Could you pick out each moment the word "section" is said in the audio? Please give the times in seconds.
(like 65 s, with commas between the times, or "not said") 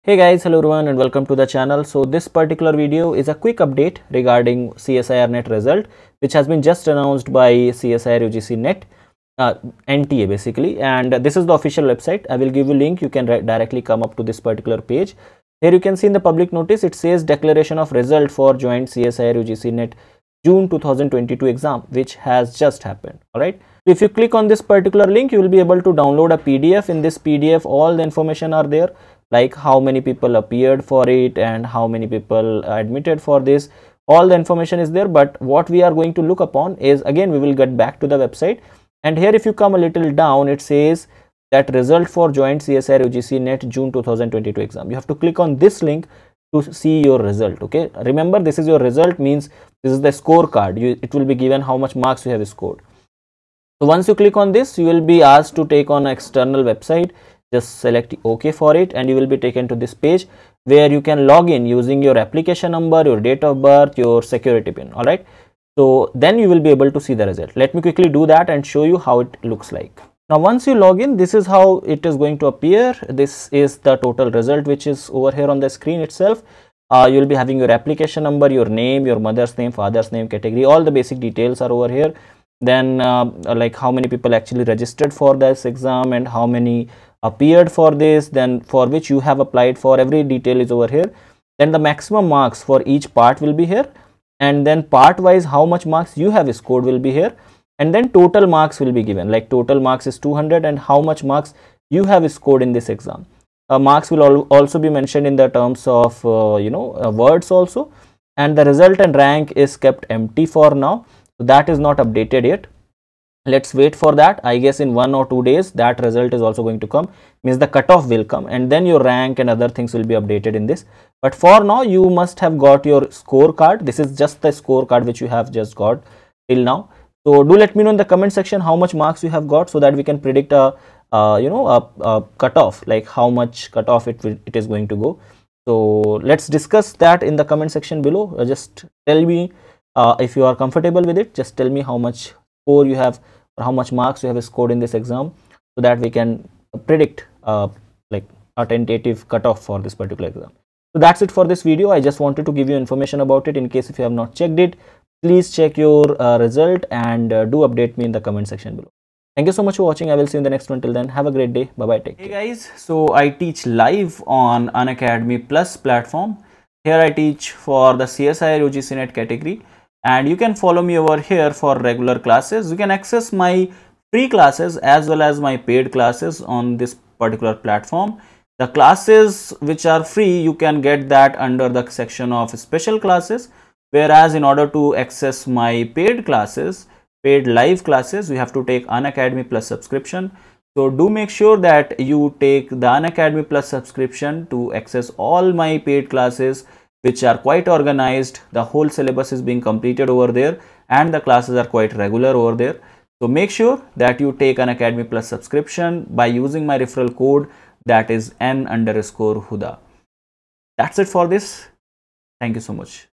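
128 s, 137 s, 158 s, 181 s.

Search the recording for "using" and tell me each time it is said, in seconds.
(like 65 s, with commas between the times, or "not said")
61 s, 206 s.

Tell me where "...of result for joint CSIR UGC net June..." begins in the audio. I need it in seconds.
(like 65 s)
17 s.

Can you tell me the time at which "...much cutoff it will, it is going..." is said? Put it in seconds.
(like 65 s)
133 s.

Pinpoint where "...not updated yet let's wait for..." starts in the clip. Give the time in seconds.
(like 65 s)
111 s.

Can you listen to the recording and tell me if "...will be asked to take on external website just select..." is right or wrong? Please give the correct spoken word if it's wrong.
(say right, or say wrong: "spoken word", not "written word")
right.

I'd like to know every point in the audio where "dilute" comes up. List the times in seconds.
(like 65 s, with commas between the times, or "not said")
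not said.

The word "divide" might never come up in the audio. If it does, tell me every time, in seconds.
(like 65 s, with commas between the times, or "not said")
not said.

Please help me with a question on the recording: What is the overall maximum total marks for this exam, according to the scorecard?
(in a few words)
200.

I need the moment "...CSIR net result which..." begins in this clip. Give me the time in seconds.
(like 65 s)
4 s.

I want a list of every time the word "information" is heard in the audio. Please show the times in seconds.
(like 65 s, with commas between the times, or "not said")
28 s, 34 s, 152 s.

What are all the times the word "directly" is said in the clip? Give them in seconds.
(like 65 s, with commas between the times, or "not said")
13 s.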